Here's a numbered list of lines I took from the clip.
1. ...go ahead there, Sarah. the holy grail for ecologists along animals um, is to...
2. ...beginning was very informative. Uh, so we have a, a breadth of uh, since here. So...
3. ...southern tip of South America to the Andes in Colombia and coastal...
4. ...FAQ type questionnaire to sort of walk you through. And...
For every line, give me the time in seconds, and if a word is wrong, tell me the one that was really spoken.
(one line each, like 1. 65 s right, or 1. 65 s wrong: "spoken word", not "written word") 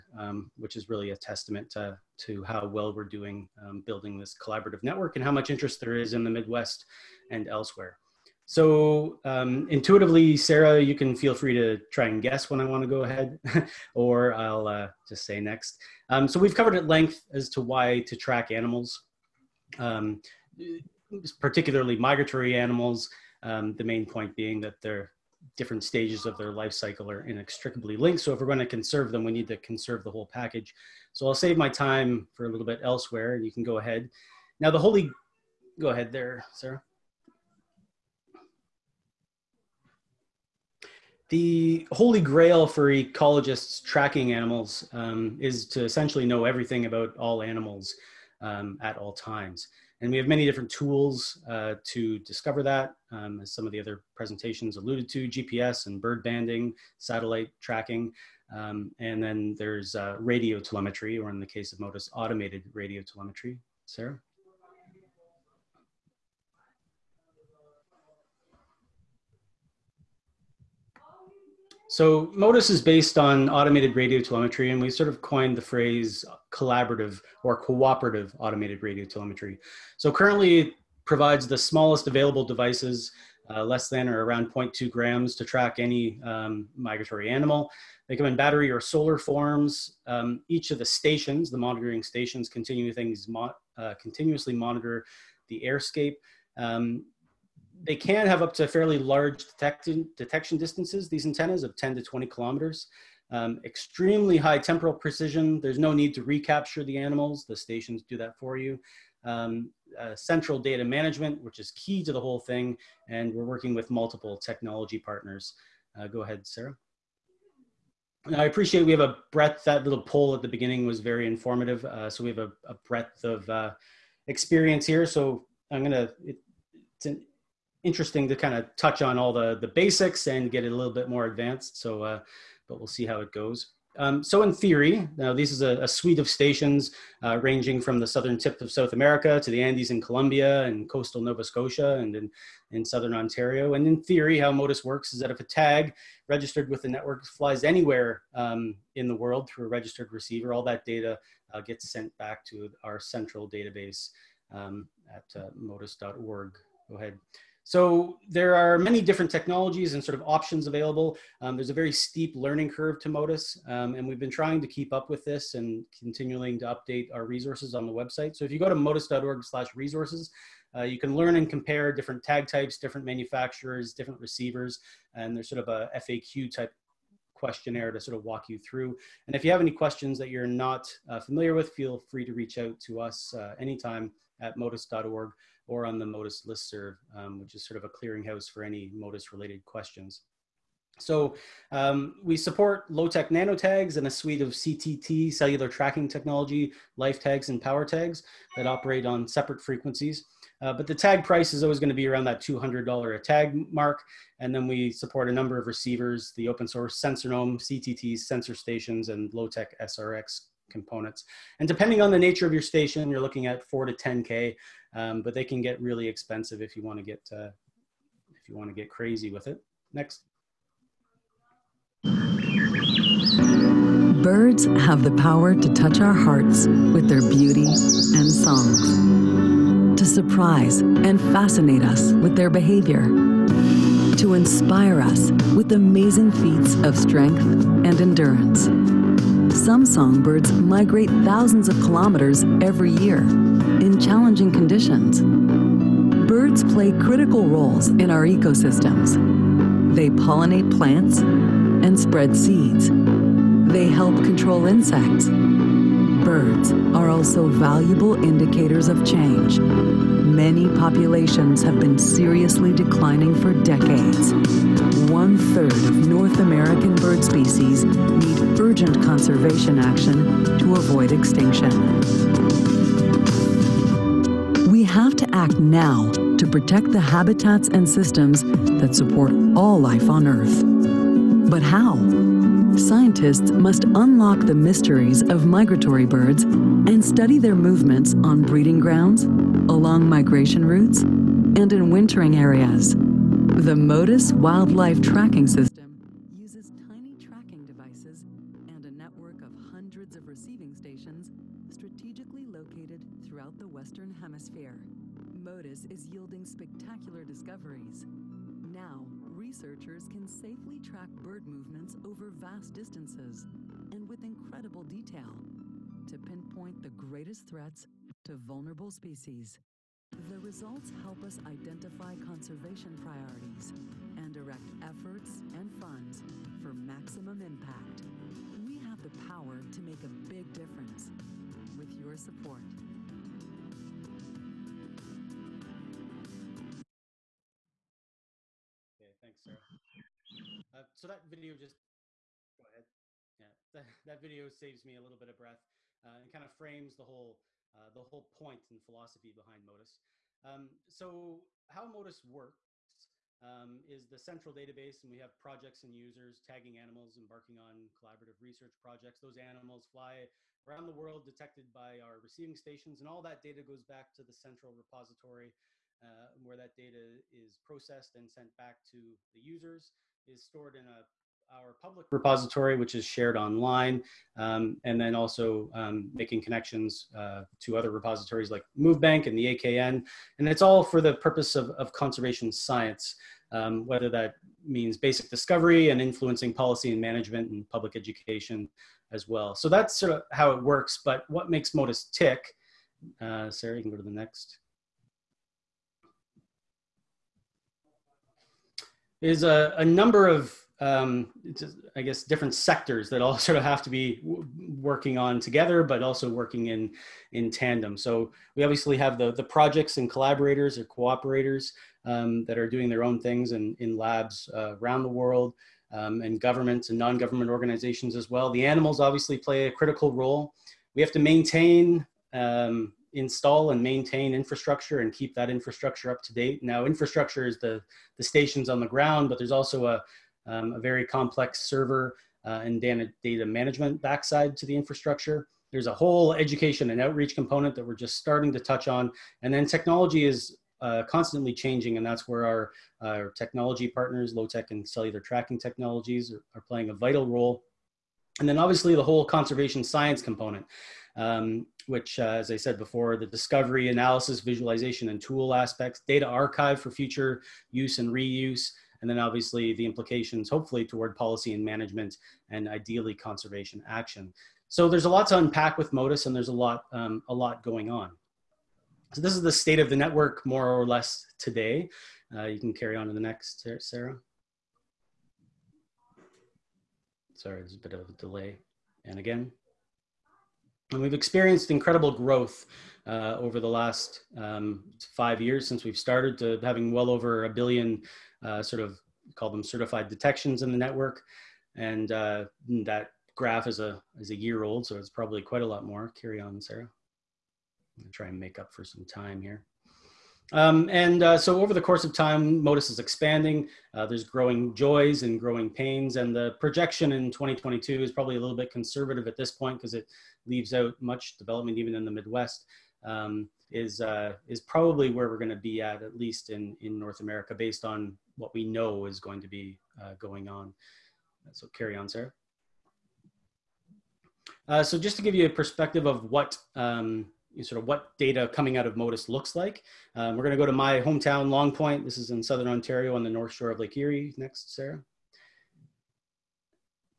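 1. 35 s wrong: "tracking", not "along"
2. 120 s wrong: "experience", not "since"
3. 138 s right
4. 175 s right.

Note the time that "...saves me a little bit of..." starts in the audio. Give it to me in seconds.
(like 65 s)
344 s.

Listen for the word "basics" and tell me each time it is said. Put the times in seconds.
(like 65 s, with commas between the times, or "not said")
129 s, 384 s.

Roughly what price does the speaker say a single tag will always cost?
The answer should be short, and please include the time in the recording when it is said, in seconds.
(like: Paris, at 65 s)
$200, at 202 s.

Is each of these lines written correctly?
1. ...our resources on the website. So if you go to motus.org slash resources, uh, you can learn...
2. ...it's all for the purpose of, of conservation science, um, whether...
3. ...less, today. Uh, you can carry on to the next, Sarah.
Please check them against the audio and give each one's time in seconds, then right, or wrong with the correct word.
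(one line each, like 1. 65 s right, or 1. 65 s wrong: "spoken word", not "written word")
1. 167 s right
2. 380 s right
3. 470 s right.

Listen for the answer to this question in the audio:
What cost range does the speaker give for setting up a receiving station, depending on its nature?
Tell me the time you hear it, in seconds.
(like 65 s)
213 s.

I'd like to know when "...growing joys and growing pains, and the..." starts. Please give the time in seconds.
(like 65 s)
504 s.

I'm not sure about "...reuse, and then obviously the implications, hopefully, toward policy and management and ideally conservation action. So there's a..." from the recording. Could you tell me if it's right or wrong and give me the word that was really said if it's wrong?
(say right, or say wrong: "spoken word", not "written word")
right.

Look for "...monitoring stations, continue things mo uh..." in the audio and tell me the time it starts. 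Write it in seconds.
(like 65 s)
91 s.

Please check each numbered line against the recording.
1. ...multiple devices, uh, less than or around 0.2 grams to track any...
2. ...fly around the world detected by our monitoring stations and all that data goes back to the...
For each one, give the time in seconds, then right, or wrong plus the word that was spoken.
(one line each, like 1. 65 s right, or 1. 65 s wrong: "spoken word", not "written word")
1. 82 s wrong: "available", not "multiple"
2. 359 s wrong: "receiving", not "monitoring".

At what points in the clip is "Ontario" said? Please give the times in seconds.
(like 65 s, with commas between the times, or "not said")
143 s, 532 s.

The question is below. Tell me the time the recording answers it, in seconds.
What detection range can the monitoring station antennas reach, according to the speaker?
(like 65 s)
101 s.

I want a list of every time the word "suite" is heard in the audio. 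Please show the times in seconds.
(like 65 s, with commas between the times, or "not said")
135 s, 194 s.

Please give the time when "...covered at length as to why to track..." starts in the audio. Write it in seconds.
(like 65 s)
16 s.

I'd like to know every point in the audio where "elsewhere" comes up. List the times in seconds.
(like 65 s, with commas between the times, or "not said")
7 s, 32 s.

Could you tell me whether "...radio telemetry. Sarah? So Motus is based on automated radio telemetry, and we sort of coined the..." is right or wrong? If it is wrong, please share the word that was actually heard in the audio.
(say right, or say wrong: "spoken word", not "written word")
right.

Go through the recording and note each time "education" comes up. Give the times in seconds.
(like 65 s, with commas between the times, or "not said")
387 s, 436 s.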